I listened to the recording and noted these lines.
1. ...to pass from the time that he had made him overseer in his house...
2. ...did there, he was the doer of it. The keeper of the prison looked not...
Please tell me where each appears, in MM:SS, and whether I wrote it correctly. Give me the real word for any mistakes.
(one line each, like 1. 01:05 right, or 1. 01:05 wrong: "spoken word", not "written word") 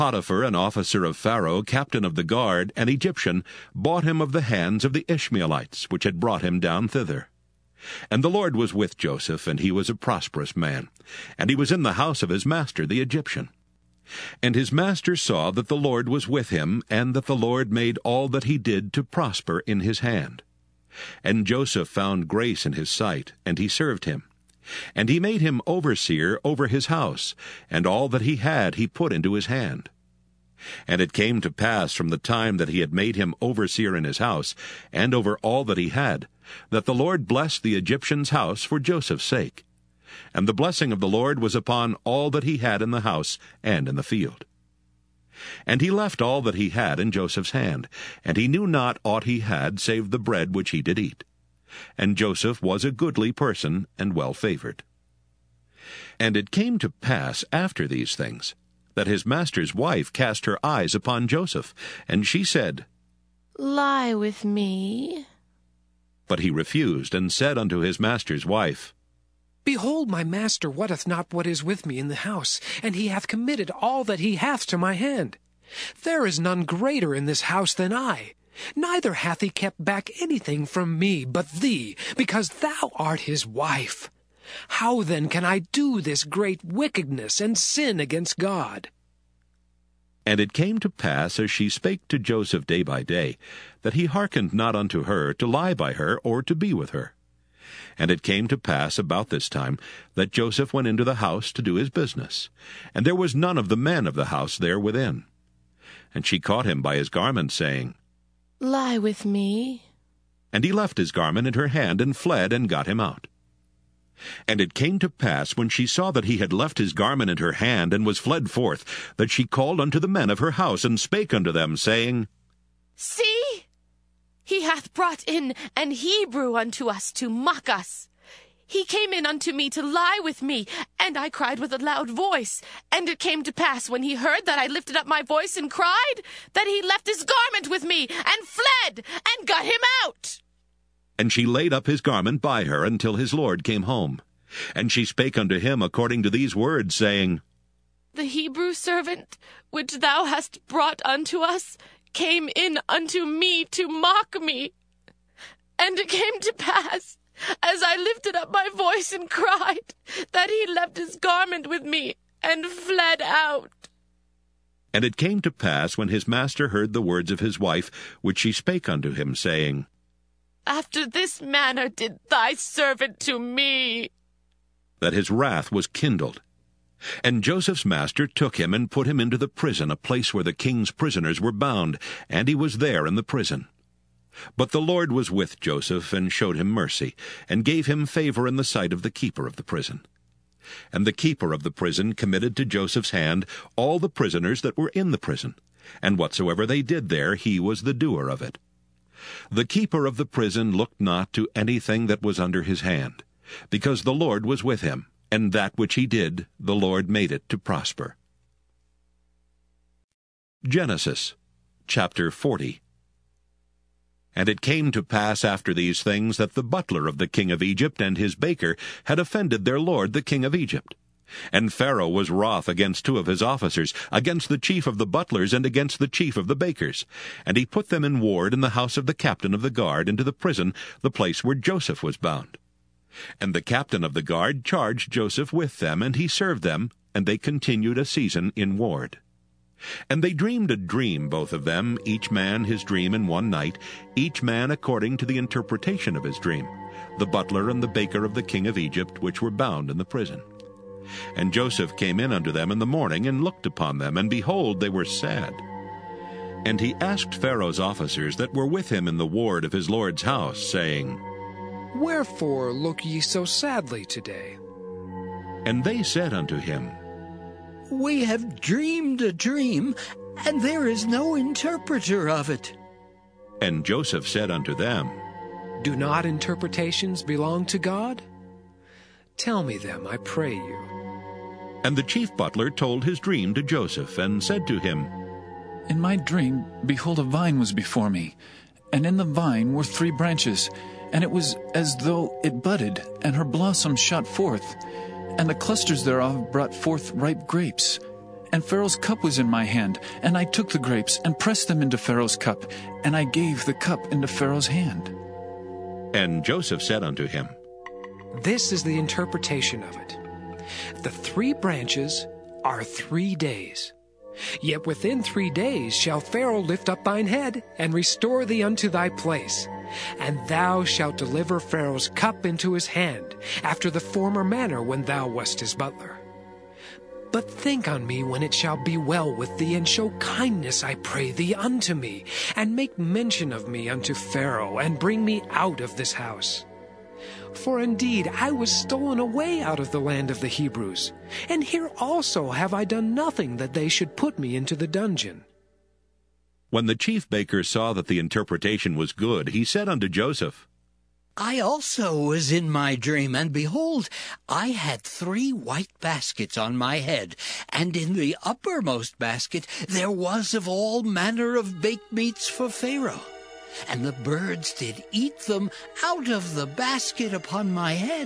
1. 00:31 right
2. 03:16 right.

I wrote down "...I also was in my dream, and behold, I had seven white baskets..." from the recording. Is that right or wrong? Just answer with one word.
wrong.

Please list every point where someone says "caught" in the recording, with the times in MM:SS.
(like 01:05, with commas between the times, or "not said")
01:46.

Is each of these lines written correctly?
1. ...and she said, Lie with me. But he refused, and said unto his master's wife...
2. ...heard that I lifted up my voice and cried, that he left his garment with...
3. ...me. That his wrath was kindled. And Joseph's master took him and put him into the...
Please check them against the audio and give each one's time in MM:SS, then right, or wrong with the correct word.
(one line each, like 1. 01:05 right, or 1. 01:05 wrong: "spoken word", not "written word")
1. 01:02 right
2. 02:14 right
3. 02:53 right.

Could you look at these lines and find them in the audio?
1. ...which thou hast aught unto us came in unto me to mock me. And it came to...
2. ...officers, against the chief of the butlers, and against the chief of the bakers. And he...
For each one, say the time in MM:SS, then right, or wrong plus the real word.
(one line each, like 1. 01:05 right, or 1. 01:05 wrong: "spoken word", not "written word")
1. 02:29 wrong: "brought", not "aught"
2. 03:43 right.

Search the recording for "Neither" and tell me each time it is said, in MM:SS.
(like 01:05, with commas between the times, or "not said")
01:18.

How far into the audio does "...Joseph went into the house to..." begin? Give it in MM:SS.
01:40.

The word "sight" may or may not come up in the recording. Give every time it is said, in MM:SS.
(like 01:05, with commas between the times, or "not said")
00:22, 03:08.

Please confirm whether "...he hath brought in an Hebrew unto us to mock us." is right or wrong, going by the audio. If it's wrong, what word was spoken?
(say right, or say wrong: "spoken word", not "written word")
right.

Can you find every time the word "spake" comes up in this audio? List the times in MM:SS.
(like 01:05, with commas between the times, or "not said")
01:31, 02:00, 02:25, 02:48.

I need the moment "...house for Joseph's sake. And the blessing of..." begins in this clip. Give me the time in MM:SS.
00:38.